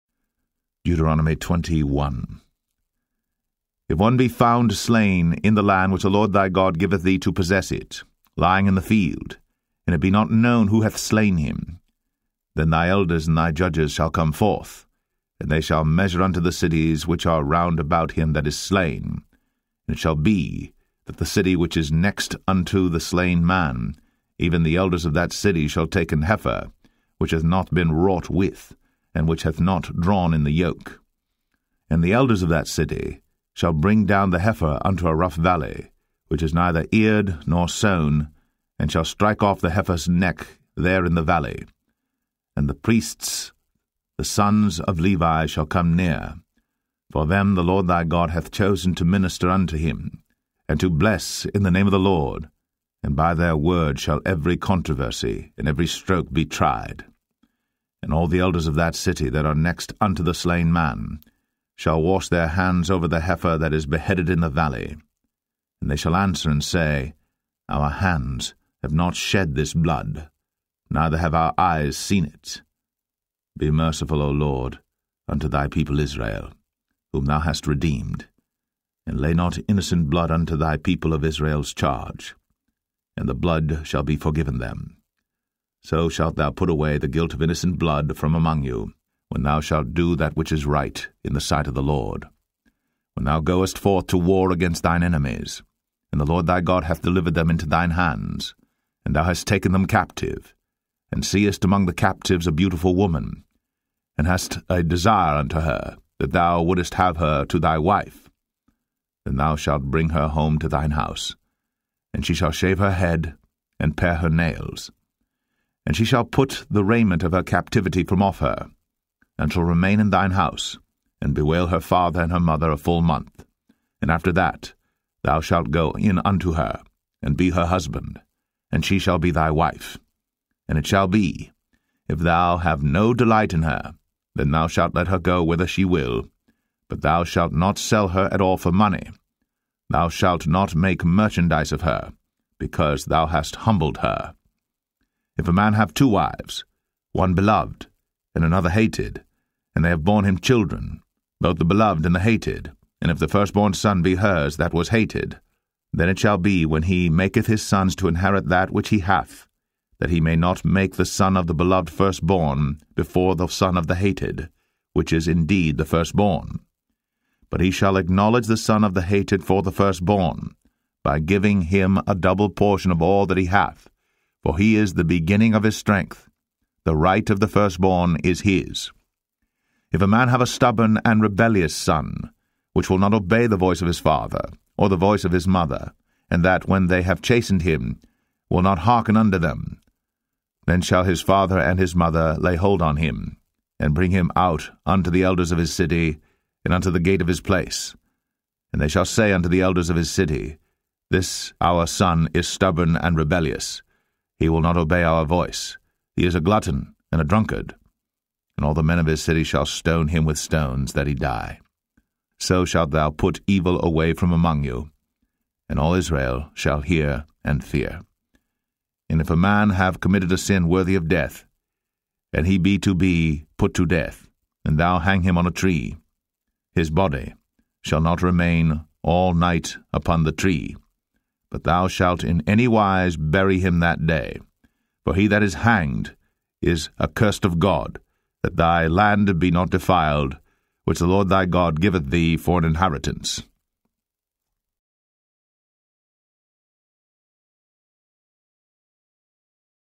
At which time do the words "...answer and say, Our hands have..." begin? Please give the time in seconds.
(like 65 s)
66 s.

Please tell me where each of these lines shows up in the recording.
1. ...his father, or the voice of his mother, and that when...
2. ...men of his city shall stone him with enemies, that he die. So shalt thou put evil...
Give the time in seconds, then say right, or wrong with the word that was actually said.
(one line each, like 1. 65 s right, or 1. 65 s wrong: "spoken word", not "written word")
1. 183 s right
2. 208 s wrong: "stones", not "enemies".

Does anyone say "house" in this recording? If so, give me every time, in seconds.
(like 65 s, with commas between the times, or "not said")
110 s, 120 s.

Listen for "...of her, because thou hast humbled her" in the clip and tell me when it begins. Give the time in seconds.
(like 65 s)
141 s.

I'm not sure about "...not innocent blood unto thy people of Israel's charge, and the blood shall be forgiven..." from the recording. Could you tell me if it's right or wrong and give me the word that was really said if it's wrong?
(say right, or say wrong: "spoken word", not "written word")
right.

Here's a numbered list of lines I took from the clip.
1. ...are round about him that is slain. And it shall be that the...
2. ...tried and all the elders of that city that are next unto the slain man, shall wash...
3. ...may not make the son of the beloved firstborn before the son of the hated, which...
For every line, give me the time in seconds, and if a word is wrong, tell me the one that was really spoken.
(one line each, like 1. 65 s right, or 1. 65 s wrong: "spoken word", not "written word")
1. 17 s right
2. 56 s right
3. 160 s right.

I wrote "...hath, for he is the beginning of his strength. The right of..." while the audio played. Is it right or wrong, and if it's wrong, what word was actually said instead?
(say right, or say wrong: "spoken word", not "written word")
right.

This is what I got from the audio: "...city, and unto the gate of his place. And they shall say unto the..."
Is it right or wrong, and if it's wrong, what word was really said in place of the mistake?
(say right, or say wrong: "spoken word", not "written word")
right.